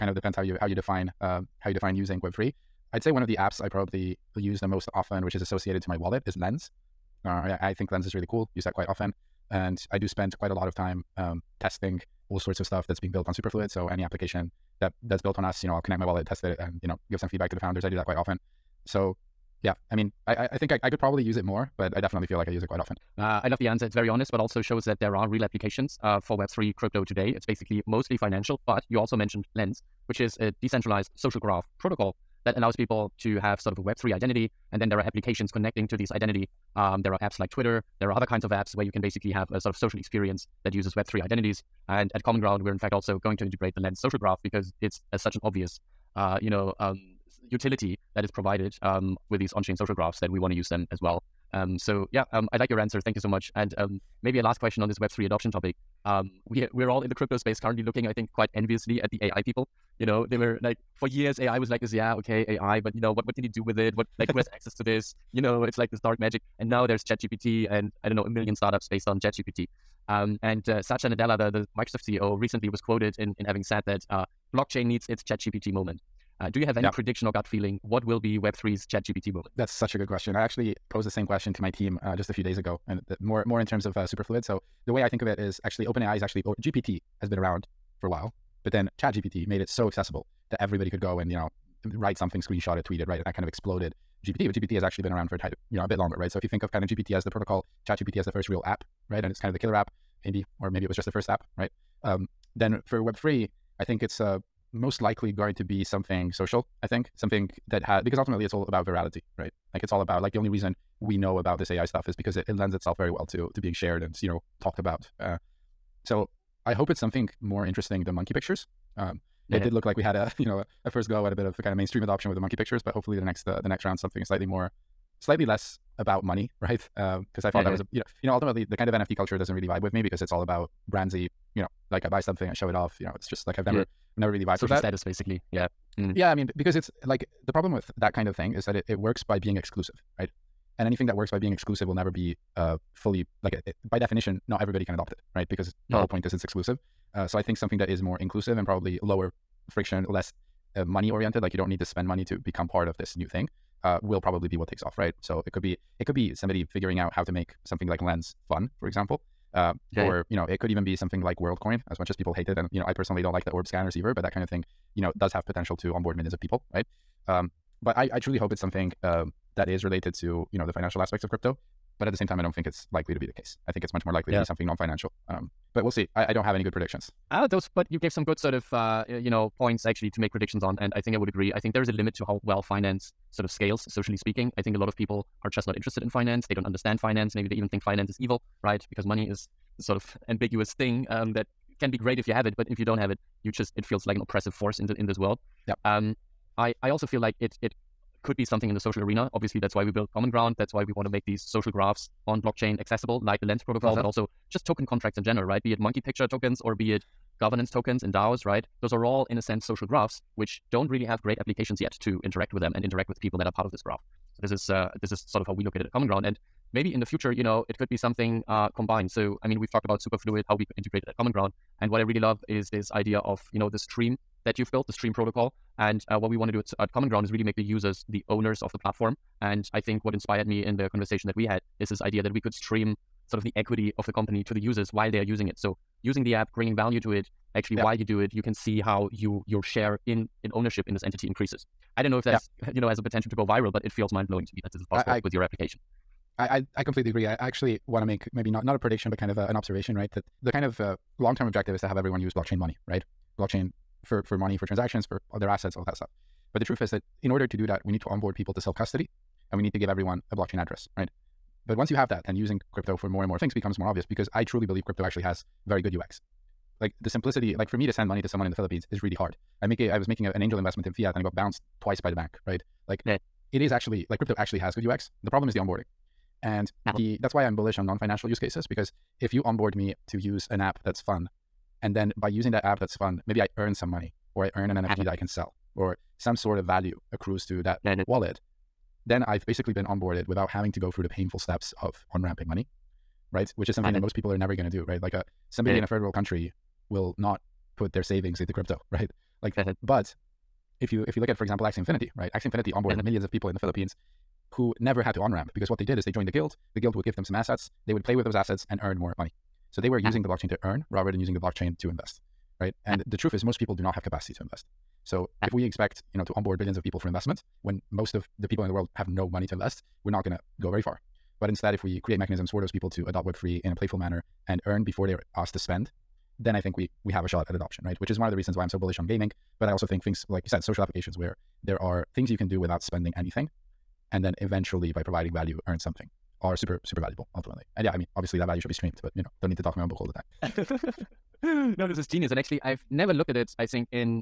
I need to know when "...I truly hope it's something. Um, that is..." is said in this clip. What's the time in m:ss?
2:48.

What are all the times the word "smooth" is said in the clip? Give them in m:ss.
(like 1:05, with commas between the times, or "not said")
not said.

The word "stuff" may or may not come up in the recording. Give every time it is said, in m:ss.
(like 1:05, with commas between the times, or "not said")
0:12, 1:51, 4:15.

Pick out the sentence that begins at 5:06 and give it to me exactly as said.
The guild would give them some assets.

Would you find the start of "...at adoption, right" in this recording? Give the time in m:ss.
5:27.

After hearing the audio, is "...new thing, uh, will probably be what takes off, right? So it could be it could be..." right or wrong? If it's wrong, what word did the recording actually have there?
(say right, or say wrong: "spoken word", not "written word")
right.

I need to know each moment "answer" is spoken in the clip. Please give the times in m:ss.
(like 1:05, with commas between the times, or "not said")
0:23, 0:52.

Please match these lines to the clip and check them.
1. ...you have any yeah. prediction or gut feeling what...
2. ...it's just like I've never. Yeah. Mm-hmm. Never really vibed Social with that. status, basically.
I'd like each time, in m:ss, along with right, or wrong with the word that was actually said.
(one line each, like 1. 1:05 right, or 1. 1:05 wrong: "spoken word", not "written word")
1. 1:16 right
2. 2:13 right.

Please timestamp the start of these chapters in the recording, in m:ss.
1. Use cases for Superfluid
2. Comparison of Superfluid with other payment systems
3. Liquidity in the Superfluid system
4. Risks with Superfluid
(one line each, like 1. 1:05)
1. 1:28
2. 2:35
3. 4:17
4. 5:35.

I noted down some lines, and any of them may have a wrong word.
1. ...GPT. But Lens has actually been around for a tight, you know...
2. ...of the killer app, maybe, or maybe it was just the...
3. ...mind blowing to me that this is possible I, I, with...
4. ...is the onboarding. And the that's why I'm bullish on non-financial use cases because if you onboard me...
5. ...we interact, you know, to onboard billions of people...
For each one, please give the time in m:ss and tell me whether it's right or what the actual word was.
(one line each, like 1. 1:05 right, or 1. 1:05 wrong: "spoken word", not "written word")
1. 1:34 wrong: "GPT", not "Lens"
2. 1:39 right
3. 4:04 right
4. 4:35 right
5. 5:15 wrong: "expect", not "interact".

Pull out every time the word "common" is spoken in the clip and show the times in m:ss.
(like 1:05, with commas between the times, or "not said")
0:42, 3:20, 3:35, 3:41, 3:46.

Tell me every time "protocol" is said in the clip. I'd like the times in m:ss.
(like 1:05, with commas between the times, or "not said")
0:31, 1:37, 3:23, 3:45.